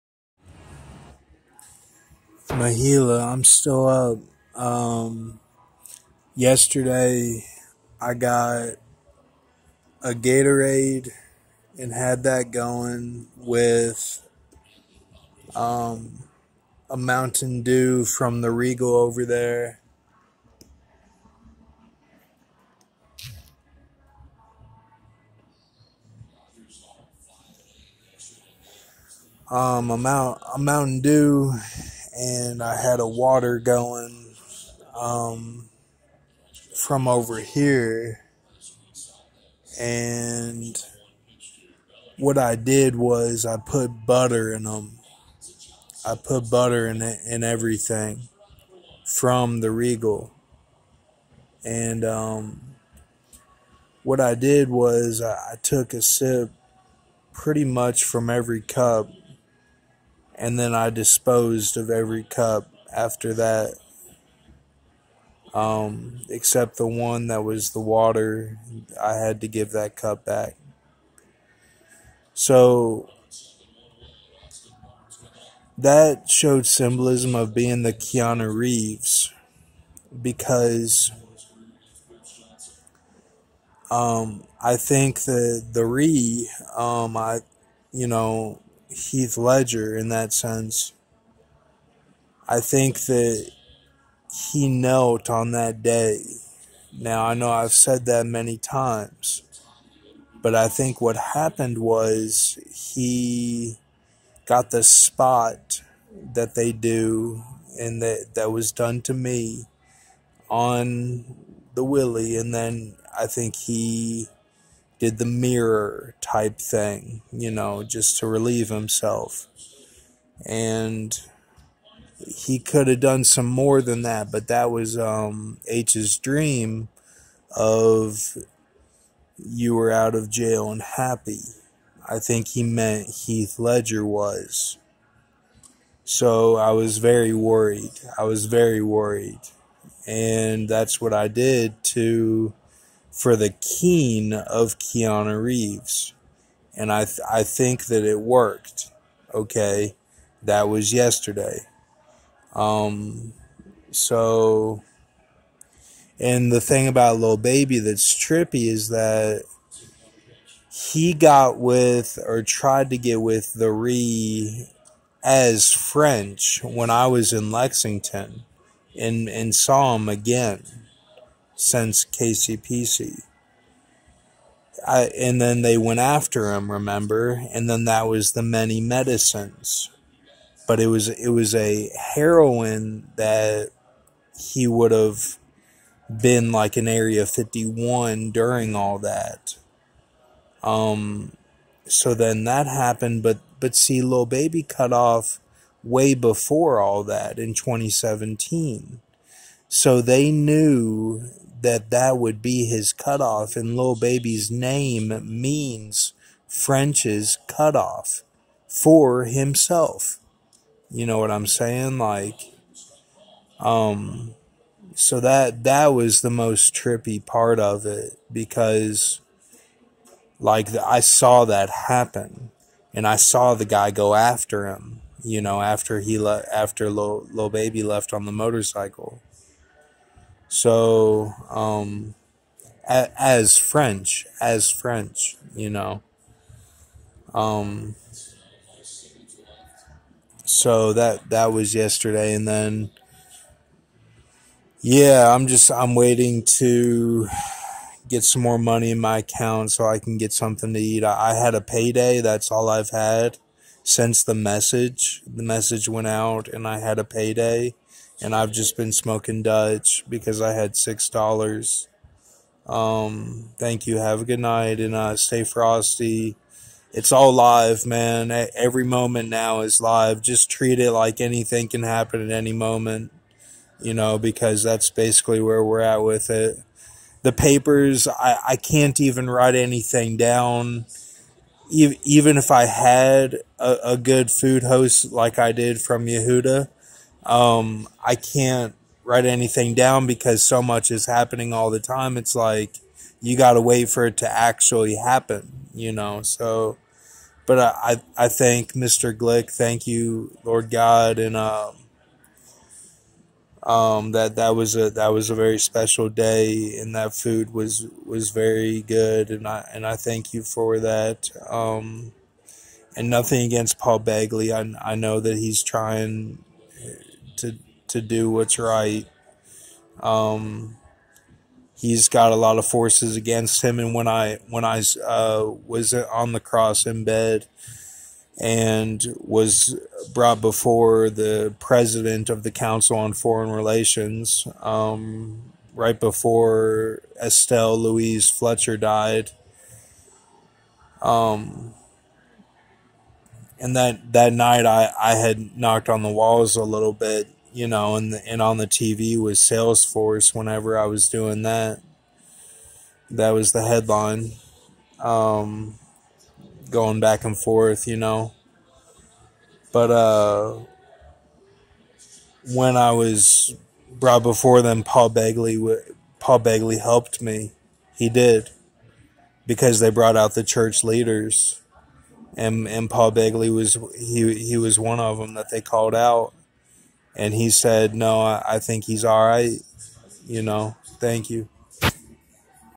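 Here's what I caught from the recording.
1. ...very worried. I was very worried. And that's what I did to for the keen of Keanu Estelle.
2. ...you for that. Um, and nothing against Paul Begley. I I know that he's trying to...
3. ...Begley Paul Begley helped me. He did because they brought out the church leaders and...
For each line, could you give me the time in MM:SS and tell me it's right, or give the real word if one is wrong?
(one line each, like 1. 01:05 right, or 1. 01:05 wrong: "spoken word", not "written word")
1. 02:16 wrong: "Reeves", not "Estelle"
2. 05:10 right
3. 06:05 right.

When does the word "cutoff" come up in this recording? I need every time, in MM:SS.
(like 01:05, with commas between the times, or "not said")
03:22, 03:27.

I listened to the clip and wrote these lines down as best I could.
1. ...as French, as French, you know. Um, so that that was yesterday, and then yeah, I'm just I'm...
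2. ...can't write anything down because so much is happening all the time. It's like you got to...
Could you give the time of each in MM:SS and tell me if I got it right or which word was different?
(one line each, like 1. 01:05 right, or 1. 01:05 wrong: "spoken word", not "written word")
1. 03:53 right
2. 04:48 right.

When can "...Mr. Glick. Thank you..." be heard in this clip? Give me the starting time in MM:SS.
04:58.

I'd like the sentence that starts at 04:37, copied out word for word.
The papers, I, I can't even write anything down.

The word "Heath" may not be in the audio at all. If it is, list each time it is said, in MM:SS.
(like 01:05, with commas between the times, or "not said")
01:28, 02:13.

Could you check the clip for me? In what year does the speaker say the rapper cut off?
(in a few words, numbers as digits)
2017.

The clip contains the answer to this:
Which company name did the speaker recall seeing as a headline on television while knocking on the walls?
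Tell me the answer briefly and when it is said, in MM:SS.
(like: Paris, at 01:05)
Salesforce, at 05:49.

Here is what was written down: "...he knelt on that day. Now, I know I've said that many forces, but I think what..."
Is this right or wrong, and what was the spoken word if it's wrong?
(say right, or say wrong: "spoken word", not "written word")
wrong: "times", not "forces".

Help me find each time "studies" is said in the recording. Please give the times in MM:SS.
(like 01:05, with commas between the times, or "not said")
not said.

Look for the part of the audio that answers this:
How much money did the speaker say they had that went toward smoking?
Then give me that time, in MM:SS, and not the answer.
04:20.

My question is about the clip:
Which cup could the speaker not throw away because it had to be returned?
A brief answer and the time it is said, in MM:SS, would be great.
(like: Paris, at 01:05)
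The water, at 01:06.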